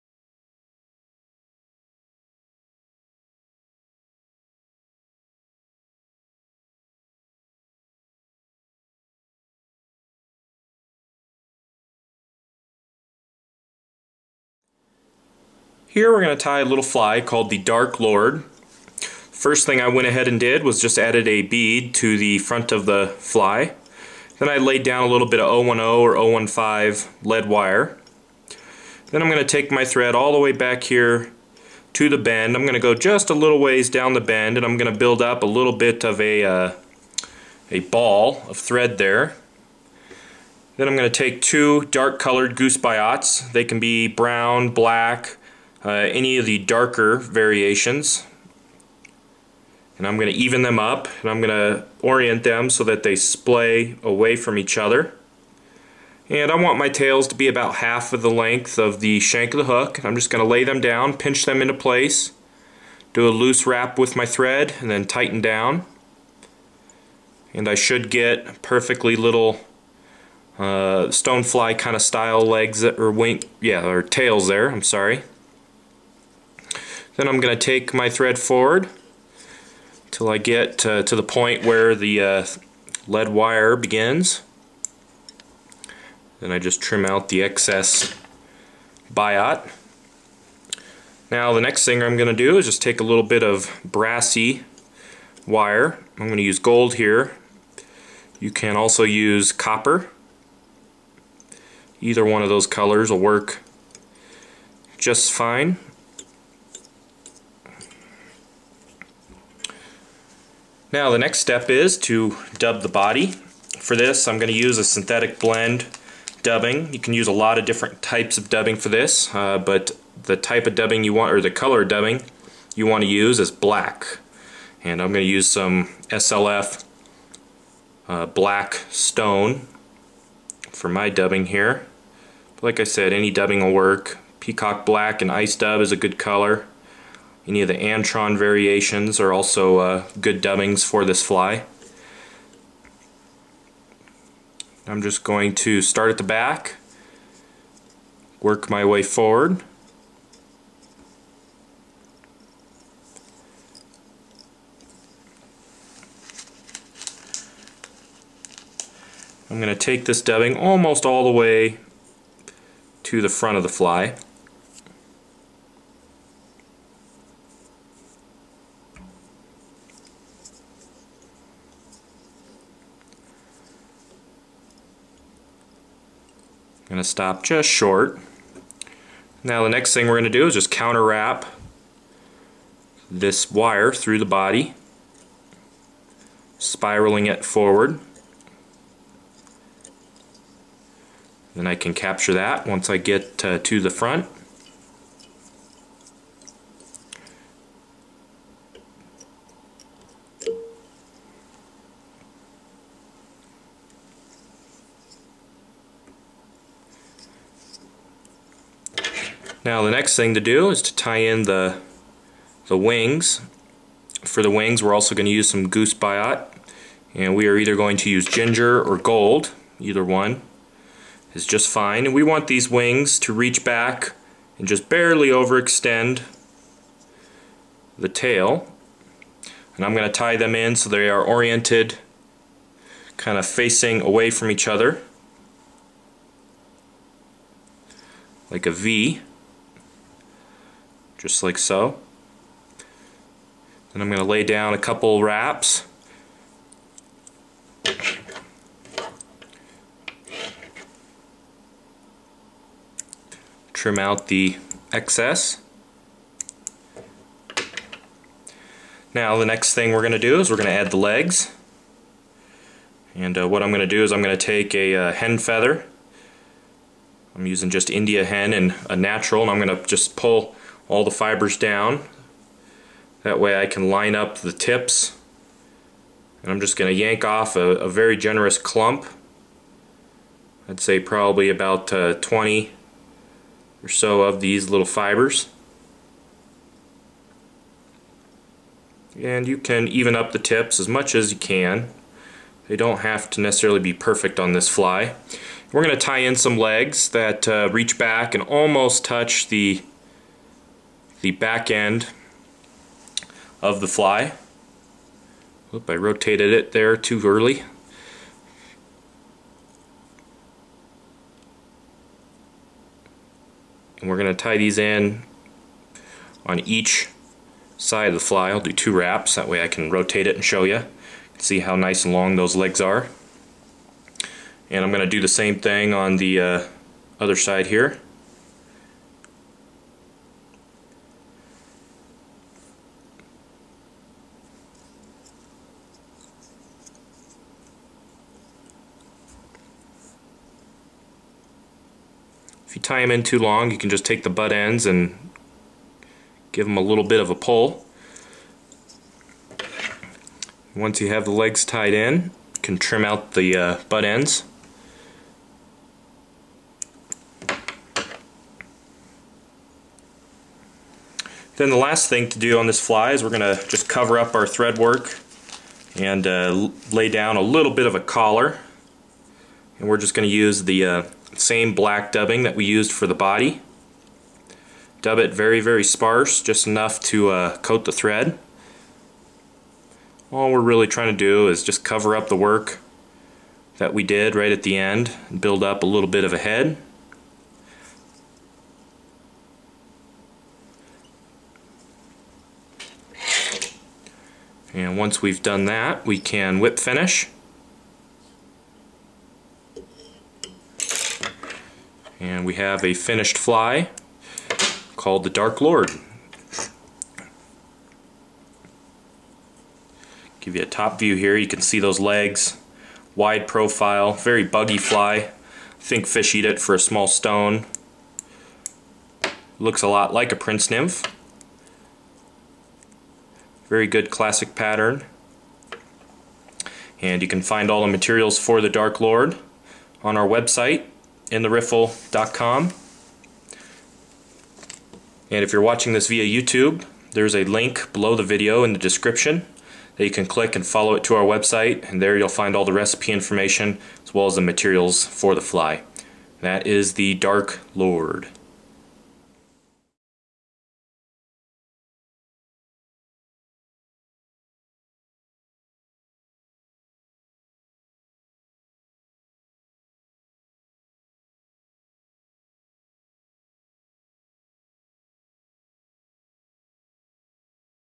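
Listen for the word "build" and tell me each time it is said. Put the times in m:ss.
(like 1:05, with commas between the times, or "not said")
0:34, 6:25.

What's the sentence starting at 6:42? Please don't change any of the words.
And we have a finished fly called the Dark Lord.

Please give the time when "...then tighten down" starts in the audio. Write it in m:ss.
1:04.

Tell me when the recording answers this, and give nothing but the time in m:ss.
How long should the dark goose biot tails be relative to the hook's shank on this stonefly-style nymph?
0:57.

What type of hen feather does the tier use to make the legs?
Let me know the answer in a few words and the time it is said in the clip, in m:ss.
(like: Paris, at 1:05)
India hen, at 4:27.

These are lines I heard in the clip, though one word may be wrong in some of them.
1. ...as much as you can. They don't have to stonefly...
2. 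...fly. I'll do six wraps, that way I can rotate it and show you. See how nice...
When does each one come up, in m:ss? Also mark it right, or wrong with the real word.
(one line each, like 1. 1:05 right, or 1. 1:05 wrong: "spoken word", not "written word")
1. 4:50 wrong: "necessarily", not "stonefly"
2. 5:18 wrong: "two", not "six".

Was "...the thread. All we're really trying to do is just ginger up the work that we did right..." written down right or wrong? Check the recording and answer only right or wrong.
wrong.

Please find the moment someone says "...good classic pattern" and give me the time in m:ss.
7:03.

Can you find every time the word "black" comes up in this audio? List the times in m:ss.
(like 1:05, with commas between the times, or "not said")
0:44, 2:03, 2:08, 2:14, 6:11.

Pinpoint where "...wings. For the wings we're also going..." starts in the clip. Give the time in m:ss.
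3:32.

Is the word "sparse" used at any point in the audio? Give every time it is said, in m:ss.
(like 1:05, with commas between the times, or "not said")
6:15.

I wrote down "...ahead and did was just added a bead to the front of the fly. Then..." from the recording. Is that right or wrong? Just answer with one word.
right.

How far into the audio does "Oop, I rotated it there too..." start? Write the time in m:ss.
5:05.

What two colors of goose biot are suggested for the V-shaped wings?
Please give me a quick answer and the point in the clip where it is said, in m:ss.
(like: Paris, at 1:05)
ginger or gold, at 3:38.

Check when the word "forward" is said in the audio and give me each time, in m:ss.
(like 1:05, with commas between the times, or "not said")
1:18, 2:29, 3:07.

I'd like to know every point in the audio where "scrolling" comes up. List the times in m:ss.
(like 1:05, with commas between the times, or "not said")
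not said.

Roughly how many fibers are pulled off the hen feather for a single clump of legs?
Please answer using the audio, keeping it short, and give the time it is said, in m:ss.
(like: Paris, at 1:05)
20, at 4:42.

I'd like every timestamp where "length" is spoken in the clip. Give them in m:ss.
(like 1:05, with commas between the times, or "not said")
0:58.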